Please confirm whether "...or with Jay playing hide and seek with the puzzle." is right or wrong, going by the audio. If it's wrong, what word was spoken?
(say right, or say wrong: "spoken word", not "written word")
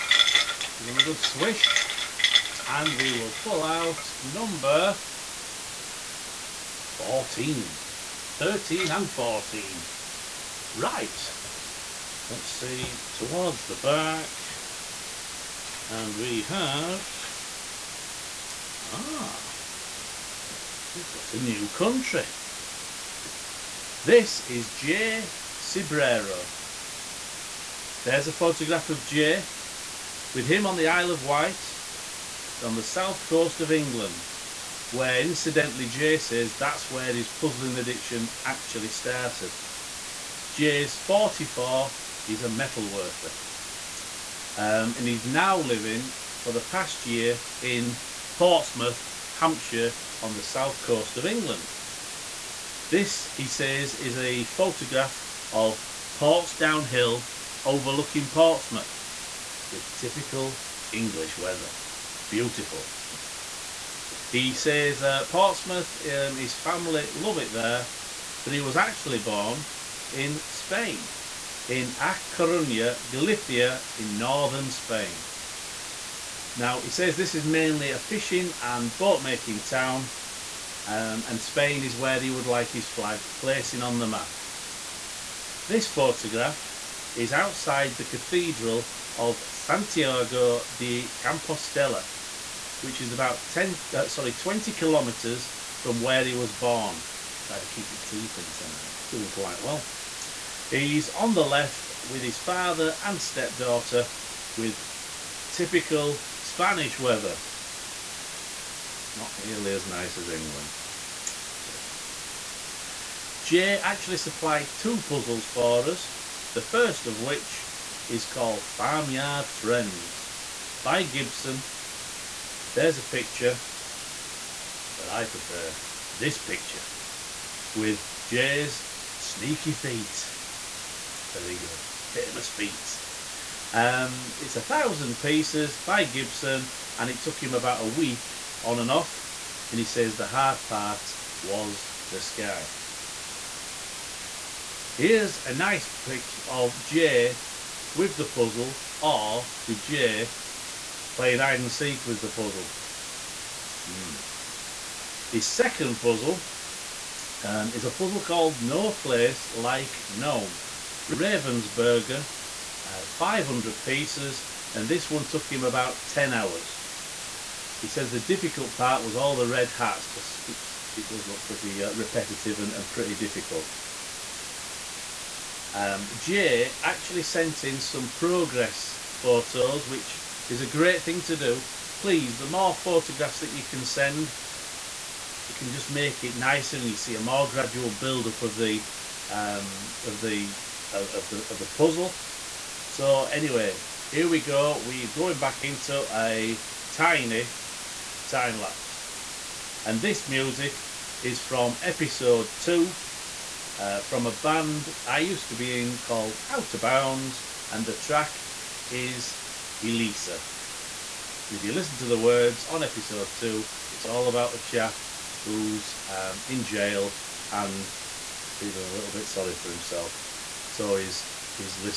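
right.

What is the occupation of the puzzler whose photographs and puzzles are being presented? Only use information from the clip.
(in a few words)
Metal worker.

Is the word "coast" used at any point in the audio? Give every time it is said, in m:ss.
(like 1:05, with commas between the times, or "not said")
0:33, 0:50.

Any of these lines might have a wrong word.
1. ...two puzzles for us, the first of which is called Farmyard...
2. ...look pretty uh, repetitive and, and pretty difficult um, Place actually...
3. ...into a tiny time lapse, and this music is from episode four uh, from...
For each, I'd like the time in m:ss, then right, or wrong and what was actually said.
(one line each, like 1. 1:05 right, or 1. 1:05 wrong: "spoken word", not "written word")
1. 1:54 right
2. 2:51 wrong: "Jay", not "Place"
3. 3:15 wrong: "two", not "four".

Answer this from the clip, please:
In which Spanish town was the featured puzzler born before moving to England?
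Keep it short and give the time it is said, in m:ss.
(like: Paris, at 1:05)
A Coruña, at 1:11.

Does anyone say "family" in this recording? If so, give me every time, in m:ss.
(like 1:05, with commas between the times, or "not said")
1:06.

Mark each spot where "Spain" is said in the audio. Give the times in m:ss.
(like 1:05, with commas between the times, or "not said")
1:10, 1:14, 1:21.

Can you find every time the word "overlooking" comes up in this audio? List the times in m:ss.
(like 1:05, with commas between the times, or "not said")
0:57.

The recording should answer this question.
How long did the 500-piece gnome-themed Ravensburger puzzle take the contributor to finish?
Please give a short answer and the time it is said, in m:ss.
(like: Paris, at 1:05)
About 10 hours, at 2:45.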